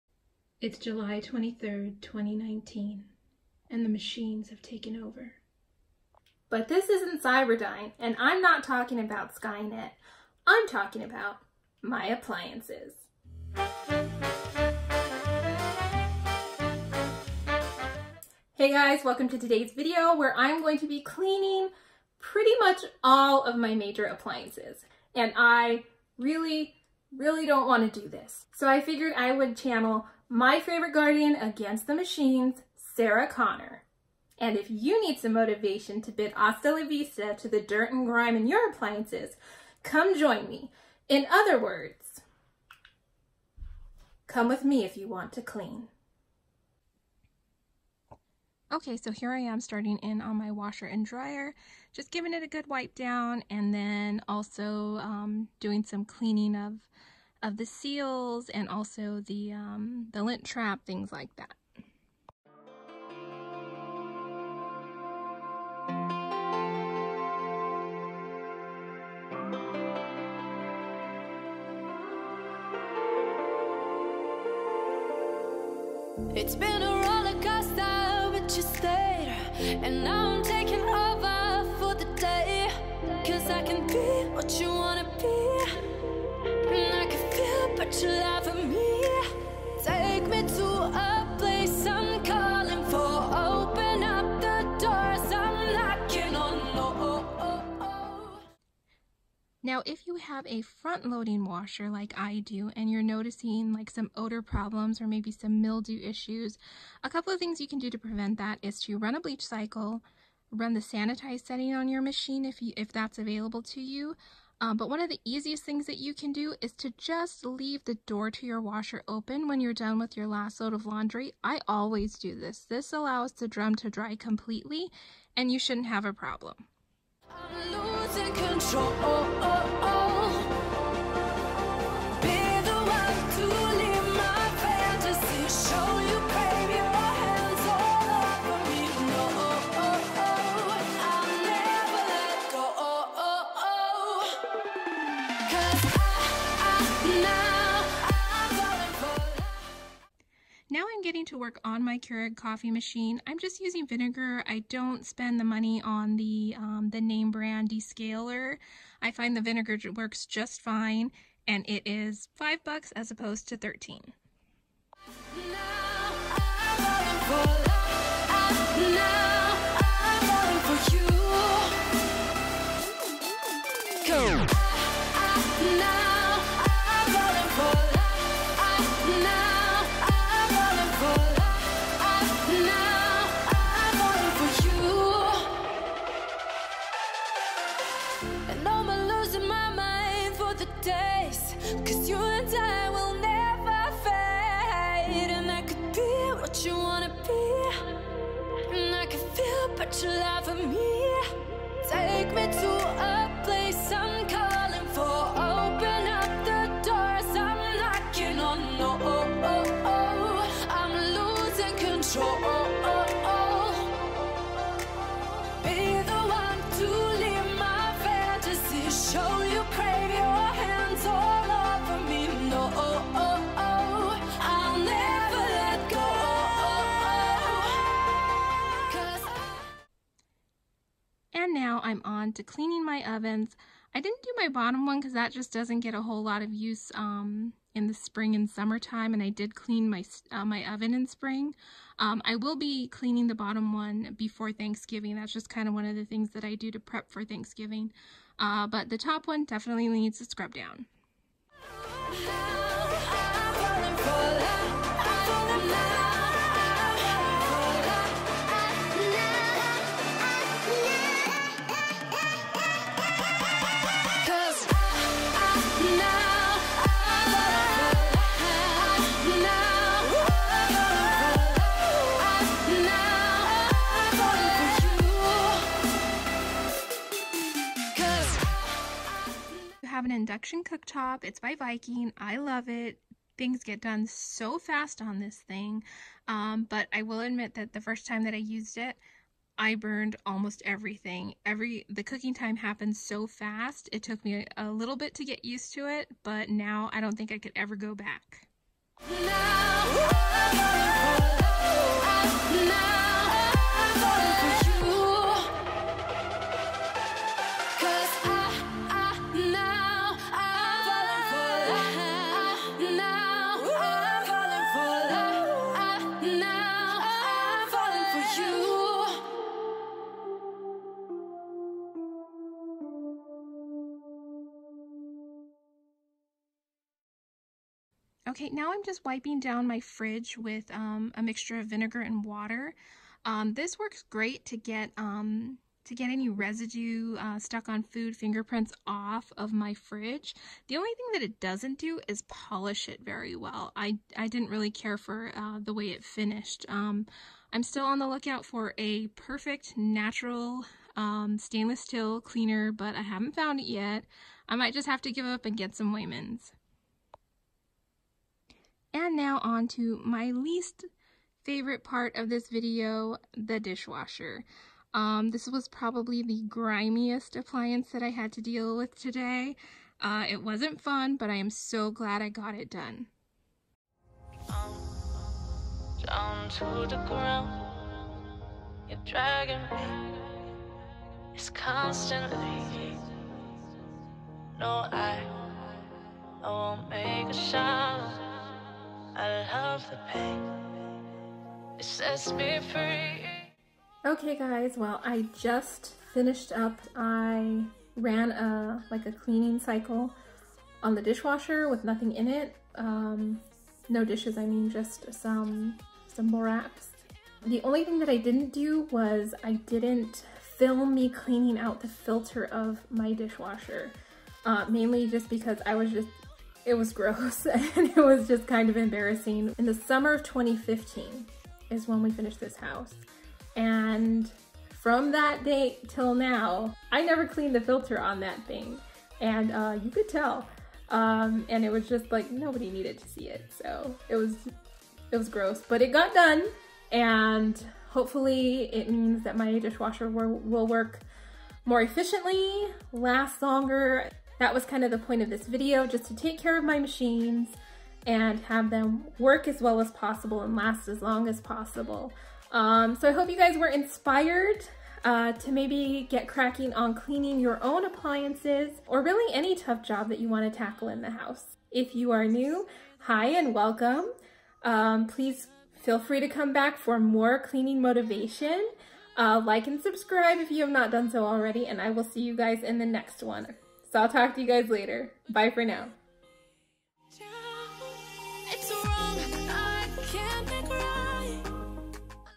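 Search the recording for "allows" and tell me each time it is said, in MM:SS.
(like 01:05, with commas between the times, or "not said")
02:02.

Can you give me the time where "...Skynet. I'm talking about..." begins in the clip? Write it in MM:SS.
00:09.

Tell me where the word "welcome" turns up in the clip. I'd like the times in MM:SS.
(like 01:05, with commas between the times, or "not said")
00:19, 07:43.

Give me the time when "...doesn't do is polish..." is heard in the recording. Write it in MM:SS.
05:41.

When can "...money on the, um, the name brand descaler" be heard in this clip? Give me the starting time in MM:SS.
02:35.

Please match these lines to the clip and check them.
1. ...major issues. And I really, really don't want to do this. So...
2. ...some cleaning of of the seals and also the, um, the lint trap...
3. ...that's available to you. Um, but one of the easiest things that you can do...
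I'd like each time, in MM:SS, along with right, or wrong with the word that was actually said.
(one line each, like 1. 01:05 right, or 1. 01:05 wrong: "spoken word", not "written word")
1. 00:23 wrong: "appliances", not "issues"
2. 00:55 right
3. 01:52 right.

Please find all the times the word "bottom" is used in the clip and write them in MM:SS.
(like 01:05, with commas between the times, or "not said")
03:54, 04:03.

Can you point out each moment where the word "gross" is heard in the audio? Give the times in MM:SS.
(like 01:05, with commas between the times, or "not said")
06:56, 07:15.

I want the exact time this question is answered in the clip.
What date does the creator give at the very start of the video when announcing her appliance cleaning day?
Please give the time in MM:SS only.
00:00.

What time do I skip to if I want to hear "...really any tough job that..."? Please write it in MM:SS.
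07:39.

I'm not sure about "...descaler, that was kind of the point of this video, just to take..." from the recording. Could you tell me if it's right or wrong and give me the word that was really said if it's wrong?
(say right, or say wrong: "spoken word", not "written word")
wrong: "longer", not "descaler".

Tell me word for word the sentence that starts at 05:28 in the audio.
Okay, now I'm just wiping down my fridge with um, a mixture of vinegar and water.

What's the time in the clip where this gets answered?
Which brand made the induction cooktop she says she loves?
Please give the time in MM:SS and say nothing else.
04:41.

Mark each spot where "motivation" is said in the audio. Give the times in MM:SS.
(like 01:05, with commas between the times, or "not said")
00:35, 07:47.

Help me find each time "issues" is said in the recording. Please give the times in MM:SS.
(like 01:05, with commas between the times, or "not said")
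01:46.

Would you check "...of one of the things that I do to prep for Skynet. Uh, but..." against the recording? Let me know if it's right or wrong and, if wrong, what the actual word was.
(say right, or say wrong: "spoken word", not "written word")
wrong: "Thanksgiving", not "Skynet".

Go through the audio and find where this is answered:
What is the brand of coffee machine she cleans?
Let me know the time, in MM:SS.
02:31.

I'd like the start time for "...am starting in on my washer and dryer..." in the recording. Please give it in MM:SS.
00:49.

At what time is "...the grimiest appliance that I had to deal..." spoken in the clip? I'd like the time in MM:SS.
06:06.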